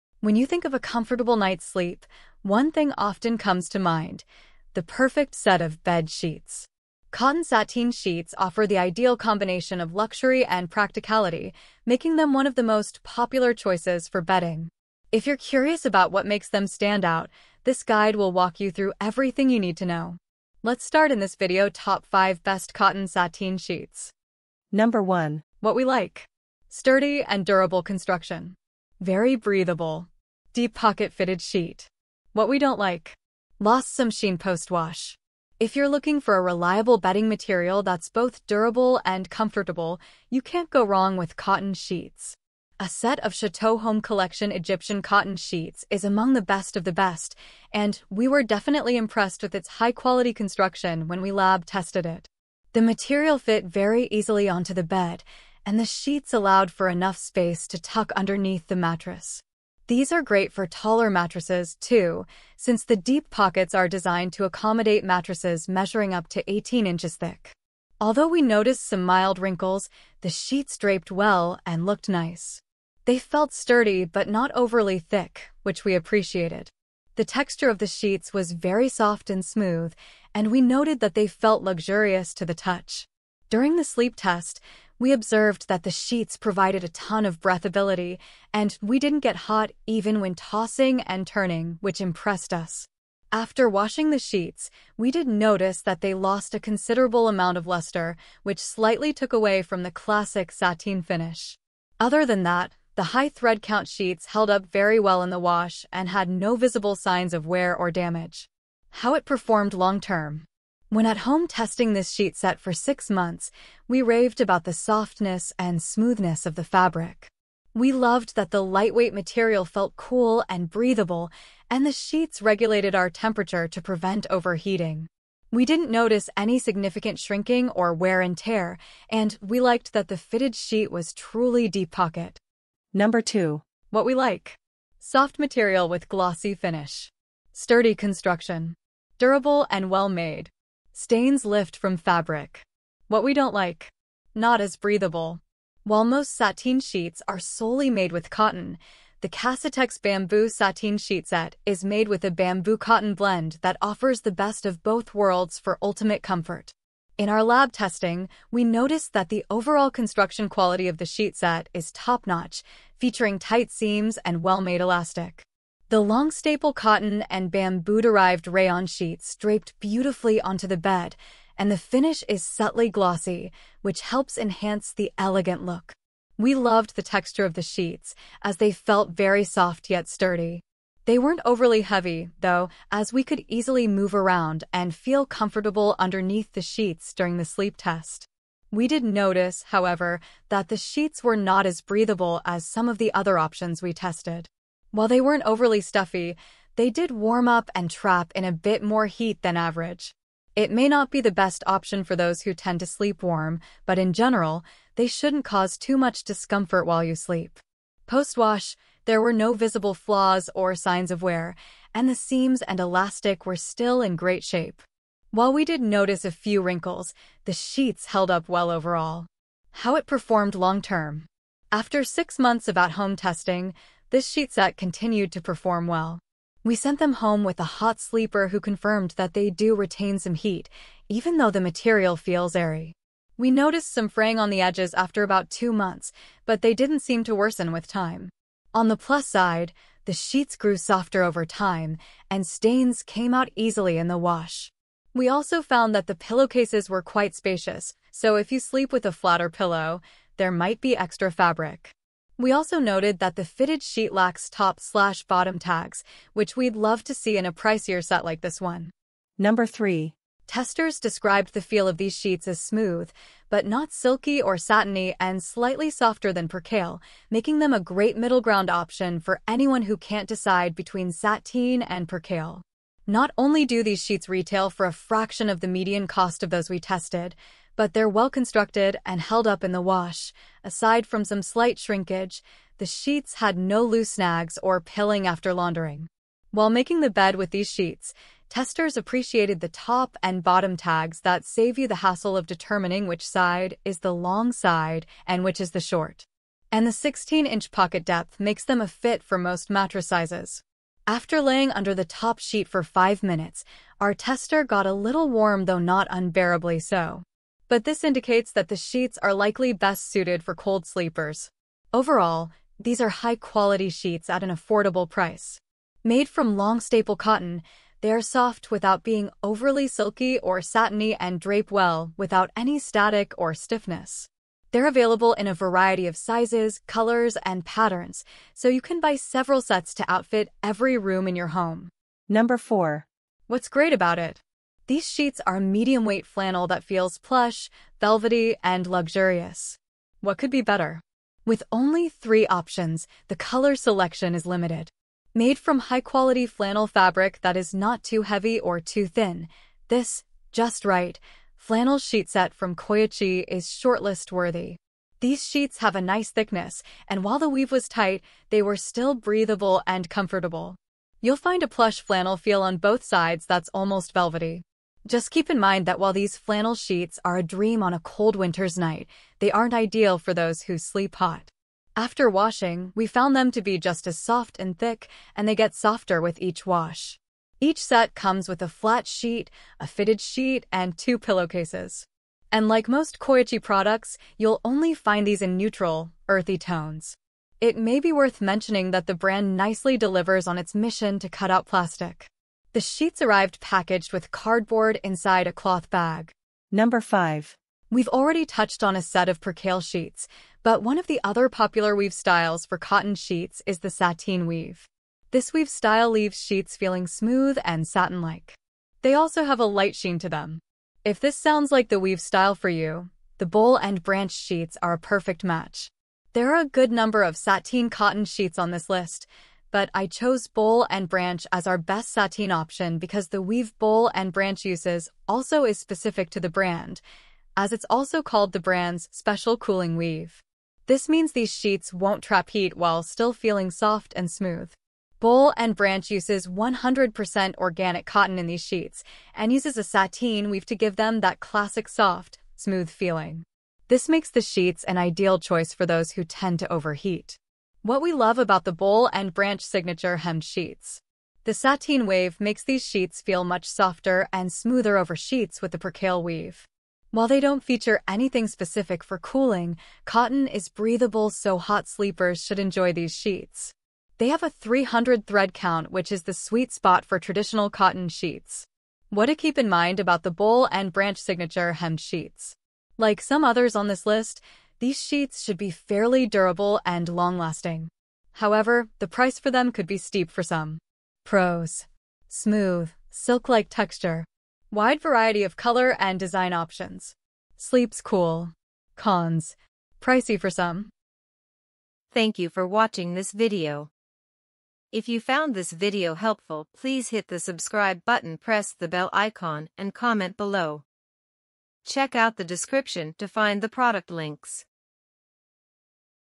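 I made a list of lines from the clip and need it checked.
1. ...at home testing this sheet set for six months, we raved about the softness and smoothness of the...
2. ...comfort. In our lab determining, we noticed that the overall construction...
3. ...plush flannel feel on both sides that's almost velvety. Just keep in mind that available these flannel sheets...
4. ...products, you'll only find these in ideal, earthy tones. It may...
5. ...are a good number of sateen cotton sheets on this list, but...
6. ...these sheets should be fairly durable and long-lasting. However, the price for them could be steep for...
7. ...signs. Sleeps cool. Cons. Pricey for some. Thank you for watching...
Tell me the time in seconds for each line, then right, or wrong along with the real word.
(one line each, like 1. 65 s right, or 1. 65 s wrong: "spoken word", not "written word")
1. 111 s right
2. 156 s wrong: "testing", not "determining"
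3. 361 s wrong: "while", not "available"
4. 383 s wrong: "neutral", not "ideal"
5. 416 s right
6. 474 s right
7. 486 s wrong: "options", not "signs".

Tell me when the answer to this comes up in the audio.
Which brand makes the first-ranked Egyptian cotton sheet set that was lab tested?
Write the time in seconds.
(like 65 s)
43 s.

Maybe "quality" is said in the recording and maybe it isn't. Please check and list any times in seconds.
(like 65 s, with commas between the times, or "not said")
49 s, 160 s, 313 s, 345 s.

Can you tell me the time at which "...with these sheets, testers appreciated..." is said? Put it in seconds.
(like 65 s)
287 s.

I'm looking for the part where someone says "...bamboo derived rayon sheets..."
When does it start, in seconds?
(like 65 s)
167 s.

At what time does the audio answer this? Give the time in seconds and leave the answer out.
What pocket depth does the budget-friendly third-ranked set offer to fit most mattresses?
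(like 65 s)
296 s.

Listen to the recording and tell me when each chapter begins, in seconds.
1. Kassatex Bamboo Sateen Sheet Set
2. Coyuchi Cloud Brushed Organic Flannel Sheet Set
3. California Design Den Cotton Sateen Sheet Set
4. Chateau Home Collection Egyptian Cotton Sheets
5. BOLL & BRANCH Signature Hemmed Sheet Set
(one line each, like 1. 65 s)
1. 132 s
2. 332 s
3. 259 s
4. 24 s
5. 396 s.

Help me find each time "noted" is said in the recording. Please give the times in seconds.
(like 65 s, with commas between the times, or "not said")
80 s, 252 s.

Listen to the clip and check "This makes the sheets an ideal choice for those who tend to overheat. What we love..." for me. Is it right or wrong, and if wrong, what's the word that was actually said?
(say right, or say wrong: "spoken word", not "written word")
right.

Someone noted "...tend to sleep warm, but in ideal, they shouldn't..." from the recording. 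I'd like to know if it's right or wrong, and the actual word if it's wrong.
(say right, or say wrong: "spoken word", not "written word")
wrong: "general", not "ideal".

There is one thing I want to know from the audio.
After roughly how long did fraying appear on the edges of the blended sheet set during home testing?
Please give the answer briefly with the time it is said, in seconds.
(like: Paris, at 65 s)
2 months, at 235 s.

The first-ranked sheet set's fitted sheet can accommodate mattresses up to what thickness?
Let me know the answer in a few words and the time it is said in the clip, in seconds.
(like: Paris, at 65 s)
18 inches, at 66 s.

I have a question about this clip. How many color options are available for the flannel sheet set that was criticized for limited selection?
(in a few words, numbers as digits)
3.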